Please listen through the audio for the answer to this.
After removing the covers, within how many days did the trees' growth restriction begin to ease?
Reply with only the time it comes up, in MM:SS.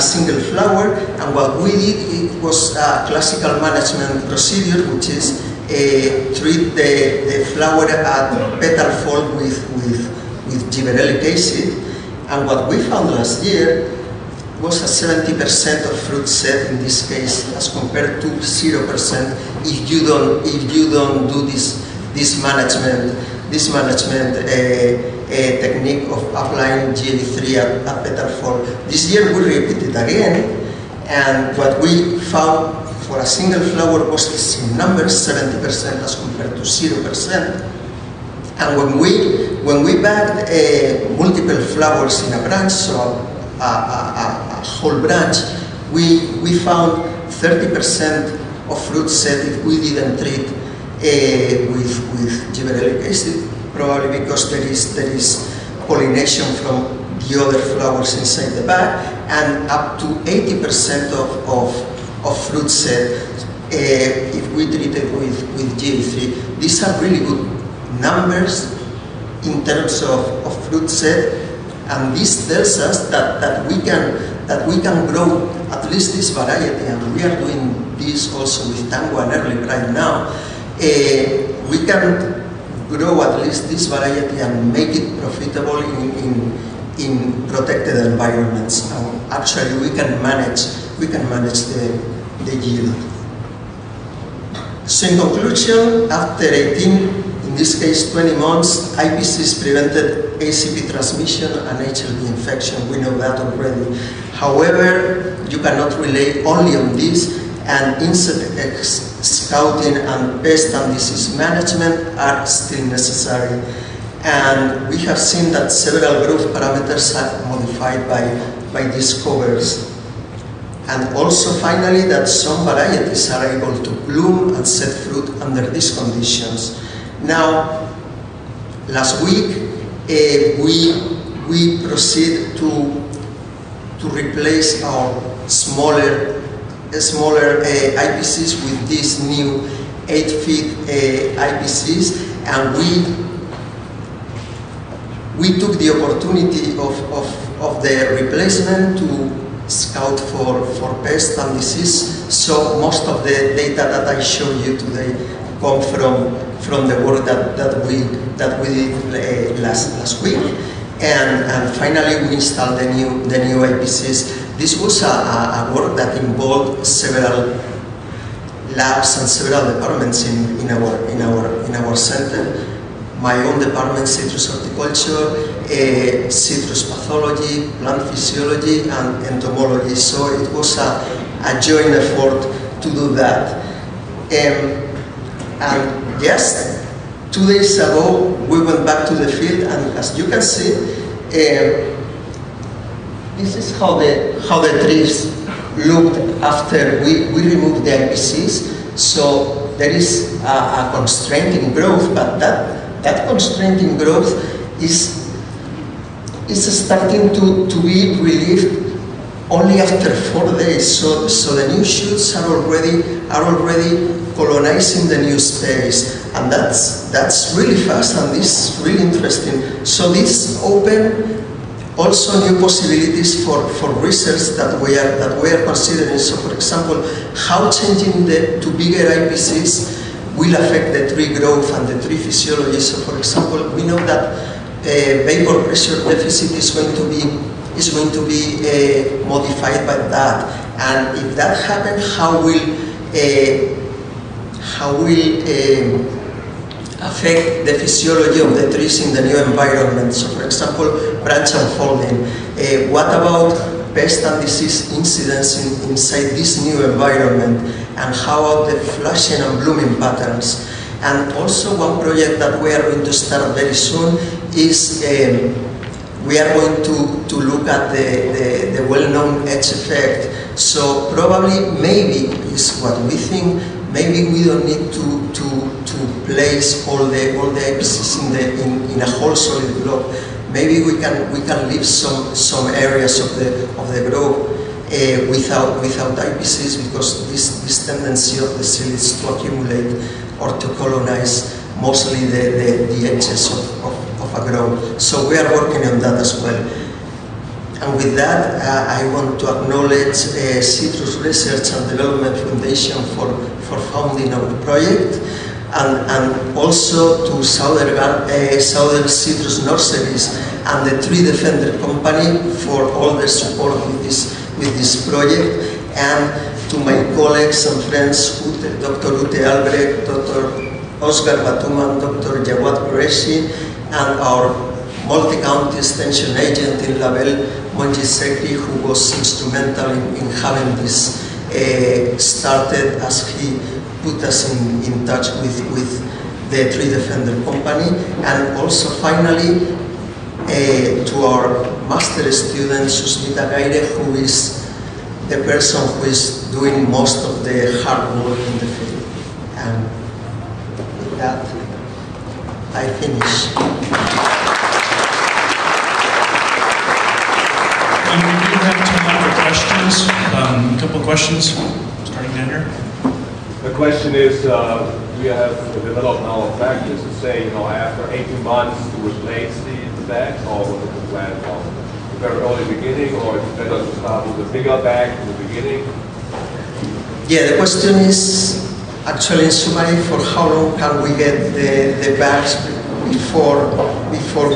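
03:30.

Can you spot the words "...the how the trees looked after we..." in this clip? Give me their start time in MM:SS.
03:13.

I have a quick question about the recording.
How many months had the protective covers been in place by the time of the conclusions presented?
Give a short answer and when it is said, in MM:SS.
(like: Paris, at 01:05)
20, at 01:38.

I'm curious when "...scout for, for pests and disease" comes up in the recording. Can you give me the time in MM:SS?
02:29.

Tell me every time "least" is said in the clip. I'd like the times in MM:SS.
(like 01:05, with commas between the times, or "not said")
01:15, 01:23.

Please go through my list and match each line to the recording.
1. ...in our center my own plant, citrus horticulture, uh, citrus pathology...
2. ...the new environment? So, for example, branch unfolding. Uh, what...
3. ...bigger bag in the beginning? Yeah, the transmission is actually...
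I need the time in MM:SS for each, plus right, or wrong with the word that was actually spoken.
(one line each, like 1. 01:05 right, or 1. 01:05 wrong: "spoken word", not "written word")
1. 02:51 wrong: "department", not "plant"
2. 04:09 right
3. 06:14 wrong: "question", not "transmission".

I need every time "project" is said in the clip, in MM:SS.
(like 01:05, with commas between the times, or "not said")
04:21, 05:04, 05:15.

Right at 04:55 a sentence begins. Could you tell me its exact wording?
So we are working on that as well.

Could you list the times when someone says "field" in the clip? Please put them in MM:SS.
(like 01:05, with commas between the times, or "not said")
03:09, 05:48.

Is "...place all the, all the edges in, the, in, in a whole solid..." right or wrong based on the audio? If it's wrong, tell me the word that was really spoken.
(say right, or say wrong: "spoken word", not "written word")
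right.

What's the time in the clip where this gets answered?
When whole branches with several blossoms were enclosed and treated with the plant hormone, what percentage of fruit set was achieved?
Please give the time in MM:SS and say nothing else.
01:00.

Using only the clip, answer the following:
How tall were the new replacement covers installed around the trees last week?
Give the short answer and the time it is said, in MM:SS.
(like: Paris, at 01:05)
8 feet, at 02:20.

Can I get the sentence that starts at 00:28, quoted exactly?
This year we repeated again and what we found for a single flower was the same number 70% as compared to 0%.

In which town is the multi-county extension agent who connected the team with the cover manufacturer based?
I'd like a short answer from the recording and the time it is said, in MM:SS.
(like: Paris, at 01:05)
LaBelle, at 05:27.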